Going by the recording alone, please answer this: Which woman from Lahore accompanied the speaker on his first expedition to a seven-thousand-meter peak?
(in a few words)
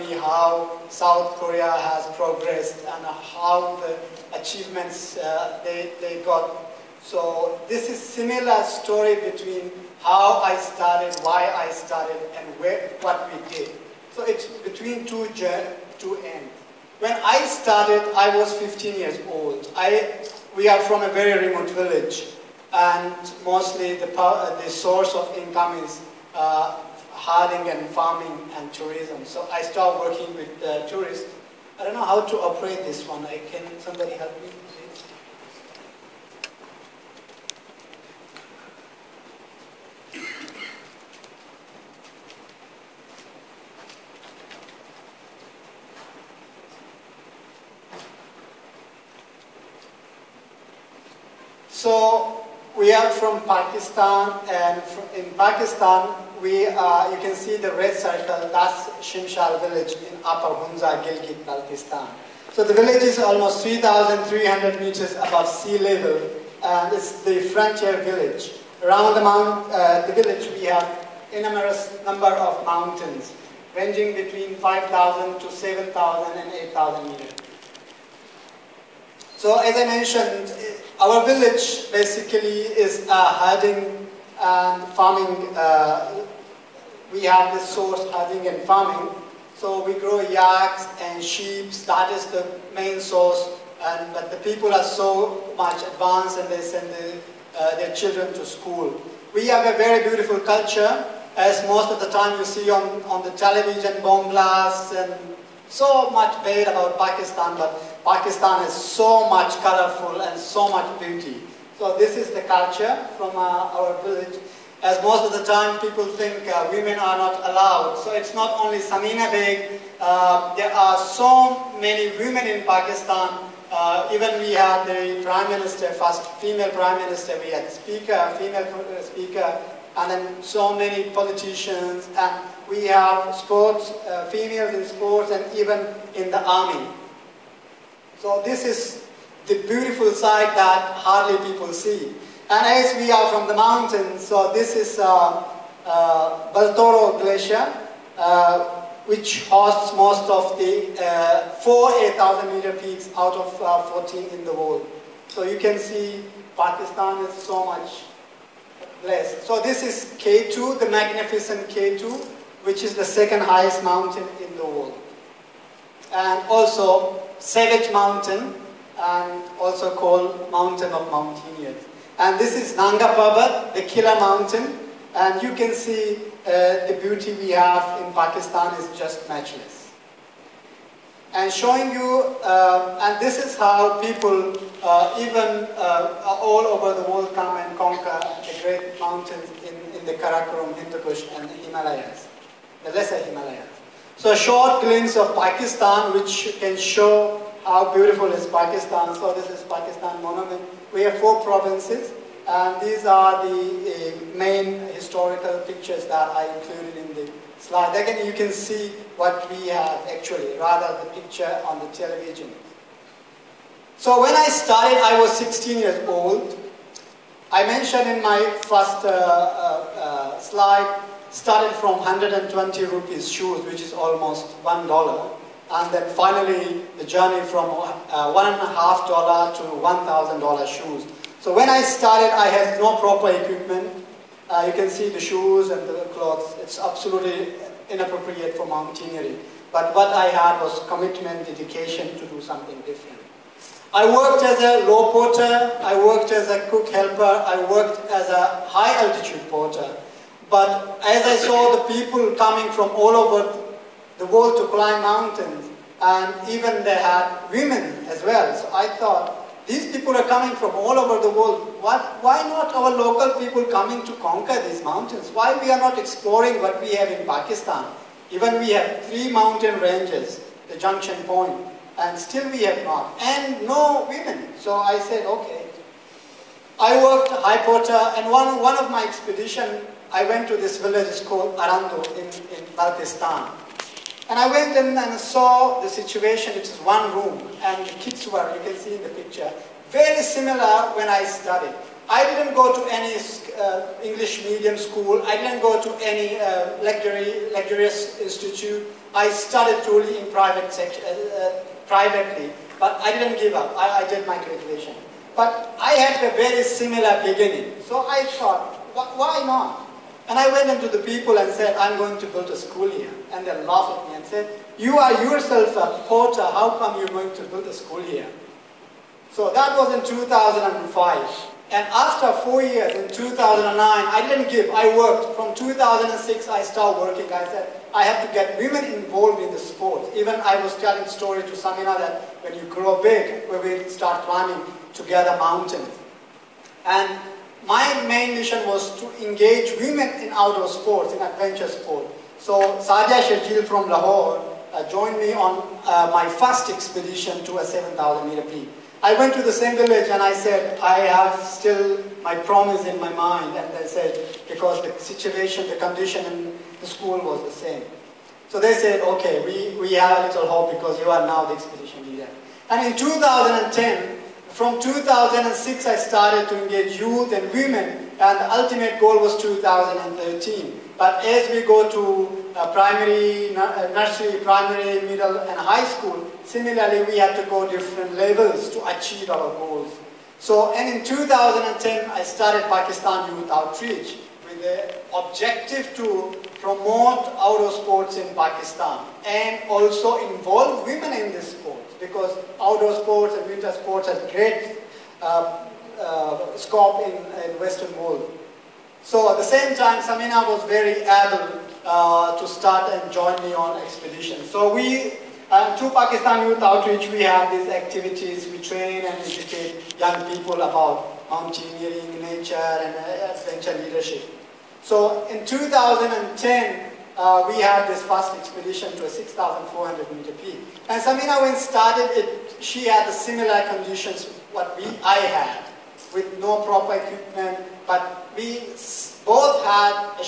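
Sadia Shajil.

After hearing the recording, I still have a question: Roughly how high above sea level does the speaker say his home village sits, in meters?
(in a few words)
3,300.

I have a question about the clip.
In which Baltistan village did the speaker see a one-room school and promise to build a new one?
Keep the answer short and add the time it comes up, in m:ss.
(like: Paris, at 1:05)
Arandu, at 4:41.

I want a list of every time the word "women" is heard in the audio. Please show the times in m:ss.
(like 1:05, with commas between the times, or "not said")
1:56, 2:02, 4:17, 4:34, 5:28, 5:39, 6:07, 6:30.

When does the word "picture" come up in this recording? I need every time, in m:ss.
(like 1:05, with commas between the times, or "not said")
3:25, 3:31, 4:49.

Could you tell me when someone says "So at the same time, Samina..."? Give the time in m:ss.
6:39.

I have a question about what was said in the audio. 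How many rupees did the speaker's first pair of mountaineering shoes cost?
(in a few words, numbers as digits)
120 rupees.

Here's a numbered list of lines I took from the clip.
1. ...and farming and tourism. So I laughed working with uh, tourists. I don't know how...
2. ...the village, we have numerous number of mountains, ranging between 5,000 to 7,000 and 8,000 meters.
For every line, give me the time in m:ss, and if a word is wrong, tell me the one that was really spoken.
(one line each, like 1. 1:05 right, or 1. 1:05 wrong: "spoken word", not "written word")
1. 0:27 wrong: "started", not "laughed"
2. 1:10 right.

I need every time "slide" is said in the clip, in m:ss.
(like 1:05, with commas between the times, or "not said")
3:27, 3:40.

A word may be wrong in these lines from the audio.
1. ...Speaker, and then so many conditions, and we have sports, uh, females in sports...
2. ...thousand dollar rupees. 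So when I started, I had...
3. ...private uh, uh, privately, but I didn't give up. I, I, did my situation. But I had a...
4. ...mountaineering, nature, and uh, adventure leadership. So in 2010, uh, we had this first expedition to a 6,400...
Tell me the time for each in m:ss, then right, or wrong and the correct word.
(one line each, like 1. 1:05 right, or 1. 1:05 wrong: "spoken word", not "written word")
1. 2:09 wrong: "politicians", not "conditions"
2. 3:50 wrong: "shoes", not "rupees"
3. 5:00 wrong: "graduation", not "situation"
4. 6:51 right.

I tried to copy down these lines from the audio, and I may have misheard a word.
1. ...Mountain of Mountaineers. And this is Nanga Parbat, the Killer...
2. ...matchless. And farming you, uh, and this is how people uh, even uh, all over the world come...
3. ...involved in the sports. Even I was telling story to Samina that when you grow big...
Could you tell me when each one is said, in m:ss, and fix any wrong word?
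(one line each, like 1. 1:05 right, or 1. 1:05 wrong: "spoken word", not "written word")
1. 2:50 right
2. 2:59 wrong: "showing", not "farming"
3. 5:28 right.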